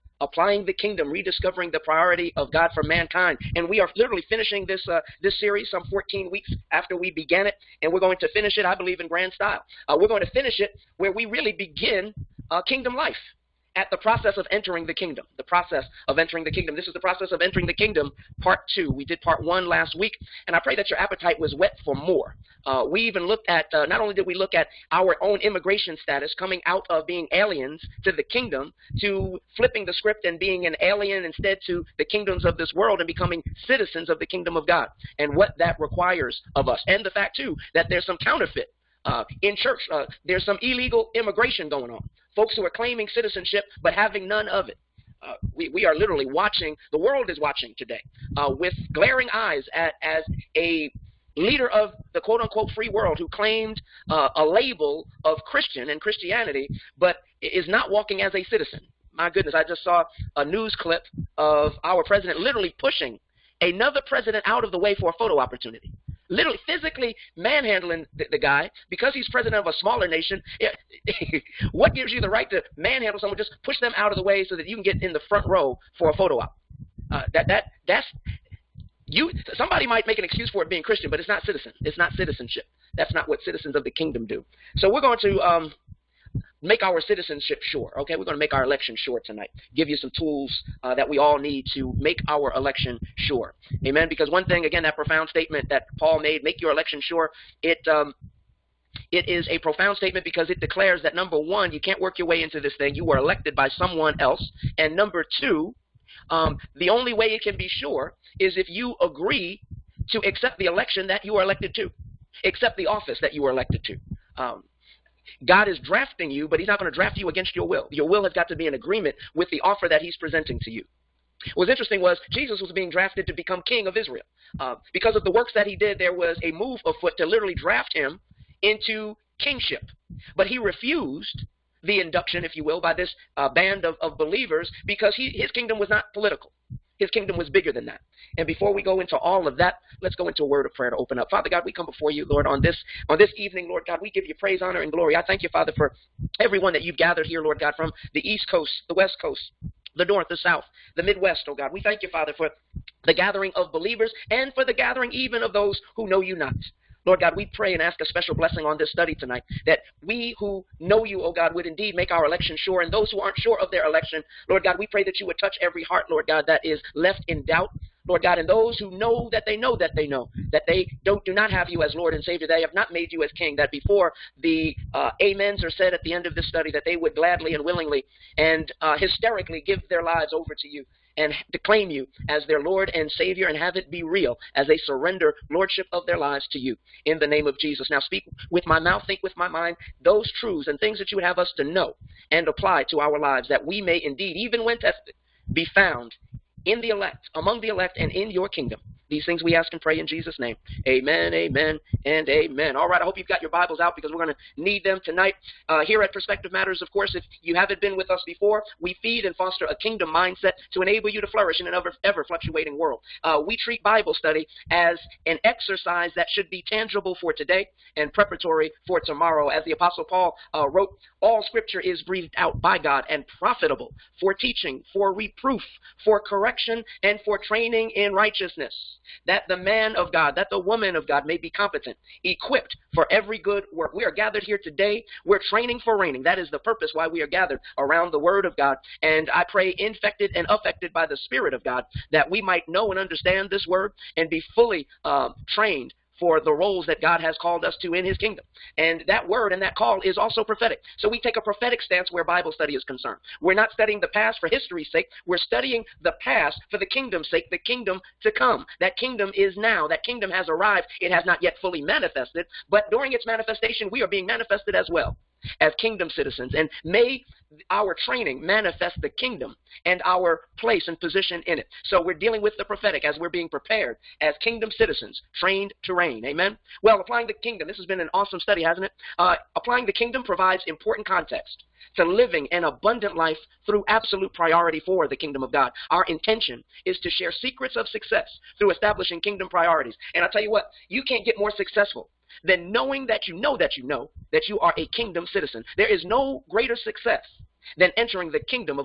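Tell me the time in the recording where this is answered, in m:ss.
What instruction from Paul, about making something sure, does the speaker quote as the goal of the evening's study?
1:36.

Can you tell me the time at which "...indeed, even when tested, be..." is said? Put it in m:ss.
3:14.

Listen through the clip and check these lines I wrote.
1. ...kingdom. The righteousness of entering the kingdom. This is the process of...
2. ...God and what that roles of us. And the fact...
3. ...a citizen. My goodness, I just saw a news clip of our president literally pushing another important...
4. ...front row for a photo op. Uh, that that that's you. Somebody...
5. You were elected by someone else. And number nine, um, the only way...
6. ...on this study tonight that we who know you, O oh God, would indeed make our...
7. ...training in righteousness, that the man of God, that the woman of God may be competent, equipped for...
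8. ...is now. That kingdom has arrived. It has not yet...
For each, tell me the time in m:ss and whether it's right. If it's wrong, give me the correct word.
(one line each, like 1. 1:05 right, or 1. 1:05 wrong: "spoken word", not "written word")
1. 0:14 wrong: "process", not "righteousness"
2. 0:34 wrong: "requires", not "roles"
3. 0:58 wrong: "president", not "important"
4. 1:15 right
5. 1:42 wrong: "two", not "nine"
6. 2:38 right
7. 3:47 right
8. 4:19 right.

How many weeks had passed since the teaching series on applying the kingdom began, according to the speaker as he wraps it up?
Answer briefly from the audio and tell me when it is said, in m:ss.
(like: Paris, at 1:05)
14, at 0:05.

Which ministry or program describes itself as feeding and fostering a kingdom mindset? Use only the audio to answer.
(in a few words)
Perspective Matters.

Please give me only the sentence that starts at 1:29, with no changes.
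Give you some tools uh, that we all need to make our election sure.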